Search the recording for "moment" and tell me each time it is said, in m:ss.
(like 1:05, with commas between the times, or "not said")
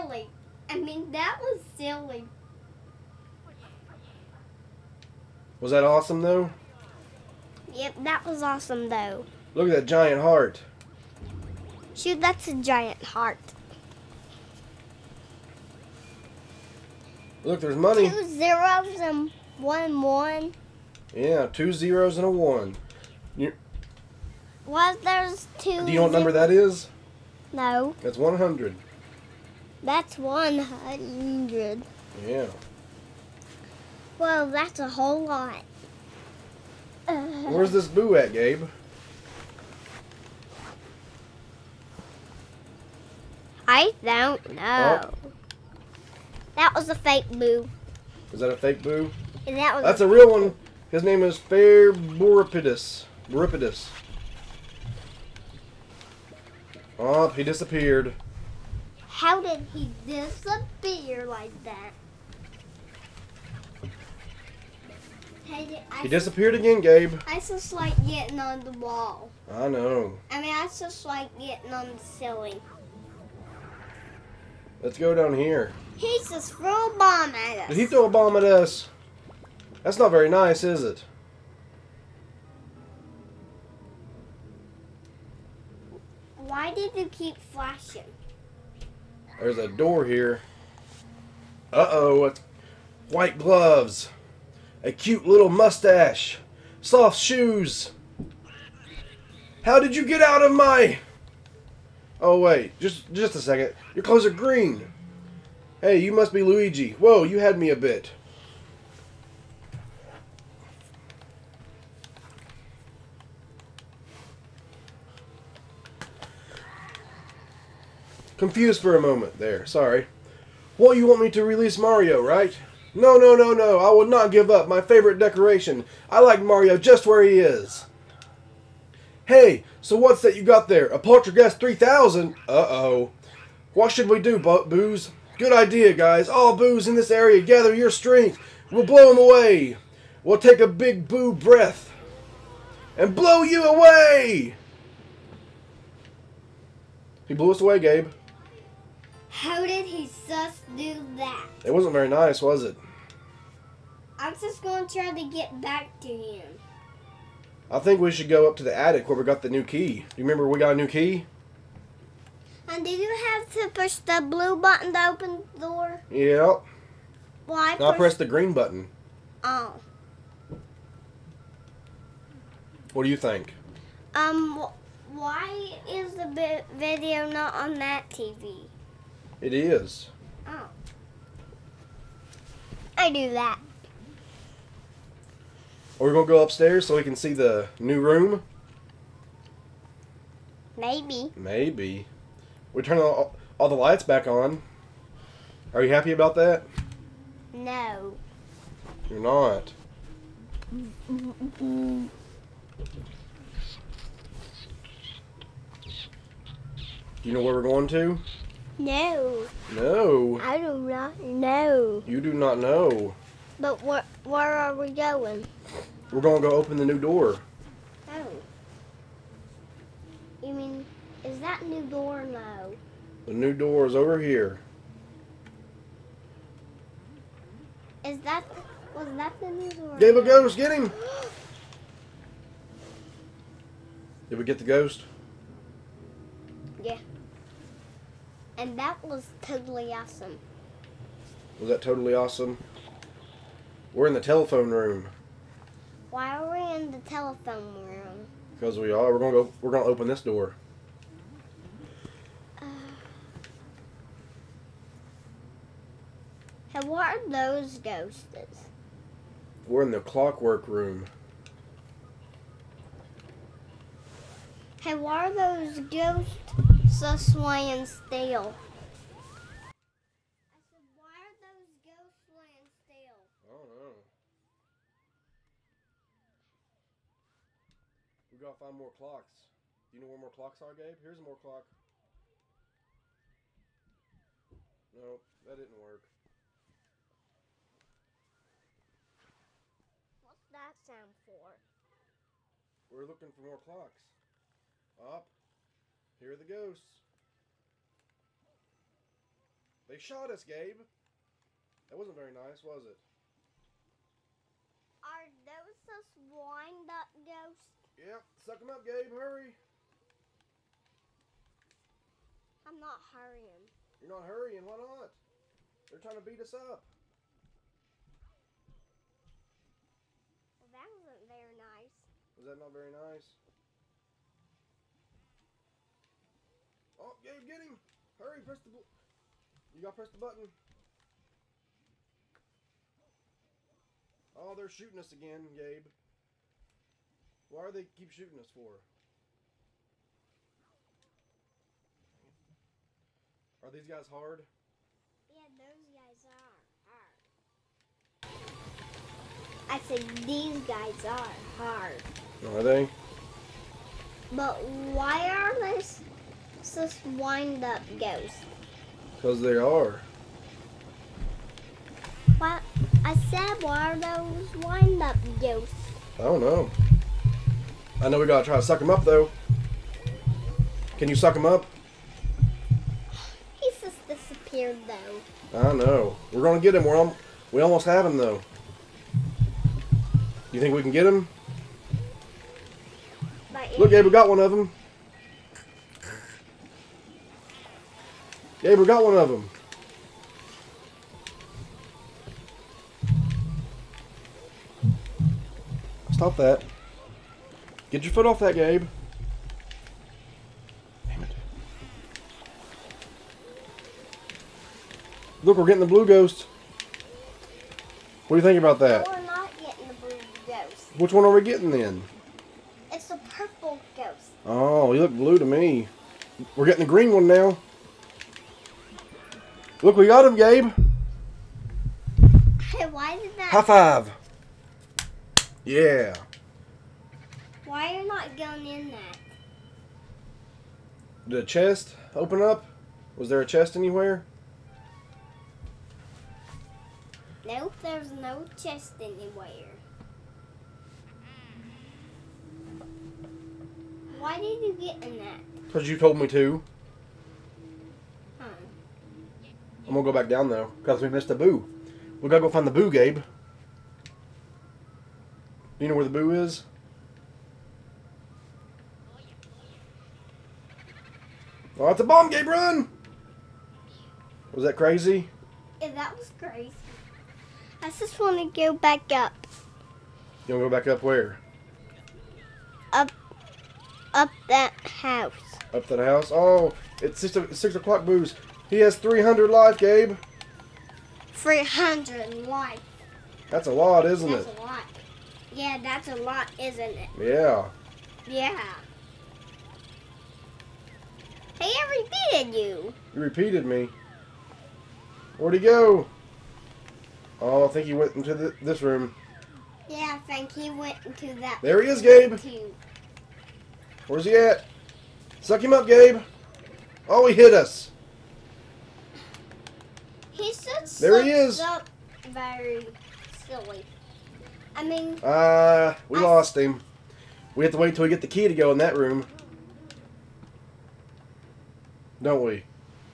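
1:59.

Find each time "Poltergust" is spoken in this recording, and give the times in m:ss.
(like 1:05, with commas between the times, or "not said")
2:10.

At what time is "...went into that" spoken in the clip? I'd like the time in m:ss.
8:20.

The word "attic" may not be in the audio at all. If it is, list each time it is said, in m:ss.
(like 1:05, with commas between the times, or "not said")
2:38.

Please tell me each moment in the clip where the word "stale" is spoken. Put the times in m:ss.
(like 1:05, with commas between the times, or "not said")
4:27, 4:32.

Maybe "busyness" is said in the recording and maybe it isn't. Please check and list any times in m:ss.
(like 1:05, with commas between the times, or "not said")
not said.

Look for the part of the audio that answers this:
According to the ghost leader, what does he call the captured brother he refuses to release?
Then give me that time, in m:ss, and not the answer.
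2:04.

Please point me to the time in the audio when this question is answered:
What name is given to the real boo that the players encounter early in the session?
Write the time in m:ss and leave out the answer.
0:51.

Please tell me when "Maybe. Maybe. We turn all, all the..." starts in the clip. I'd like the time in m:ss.
3:10.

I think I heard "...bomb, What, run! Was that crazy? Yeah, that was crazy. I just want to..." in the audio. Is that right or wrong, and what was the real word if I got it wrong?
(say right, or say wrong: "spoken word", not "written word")
wrong: "Gabe", not "What".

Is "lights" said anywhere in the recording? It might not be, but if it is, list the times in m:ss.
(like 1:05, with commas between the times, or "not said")
3:13.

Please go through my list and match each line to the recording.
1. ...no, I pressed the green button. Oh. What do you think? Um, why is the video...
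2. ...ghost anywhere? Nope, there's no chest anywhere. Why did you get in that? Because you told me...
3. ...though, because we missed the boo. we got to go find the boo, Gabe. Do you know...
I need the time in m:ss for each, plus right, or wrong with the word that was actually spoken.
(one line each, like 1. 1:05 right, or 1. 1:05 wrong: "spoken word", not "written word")
1. 2:47 right
2. 7:13 wrong: "chest", not "ghost"
3. 7:30 right.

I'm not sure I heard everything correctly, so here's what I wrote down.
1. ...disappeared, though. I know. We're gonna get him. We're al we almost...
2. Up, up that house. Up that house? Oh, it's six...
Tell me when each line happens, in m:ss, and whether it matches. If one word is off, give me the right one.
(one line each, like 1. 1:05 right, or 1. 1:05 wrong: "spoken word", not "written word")
1. 6:14 right
2. 7:52 right.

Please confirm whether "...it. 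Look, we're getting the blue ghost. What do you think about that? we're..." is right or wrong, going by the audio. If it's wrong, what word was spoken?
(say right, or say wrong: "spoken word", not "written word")
right.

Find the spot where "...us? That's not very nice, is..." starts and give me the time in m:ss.
1:18.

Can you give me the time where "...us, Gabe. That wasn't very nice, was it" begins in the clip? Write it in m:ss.
5:00.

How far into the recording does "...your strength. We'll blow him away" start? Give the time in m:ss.
2:17.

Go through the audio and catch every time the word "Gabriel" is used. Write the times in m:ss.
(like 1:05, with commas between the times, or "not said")
6:23, 6:28.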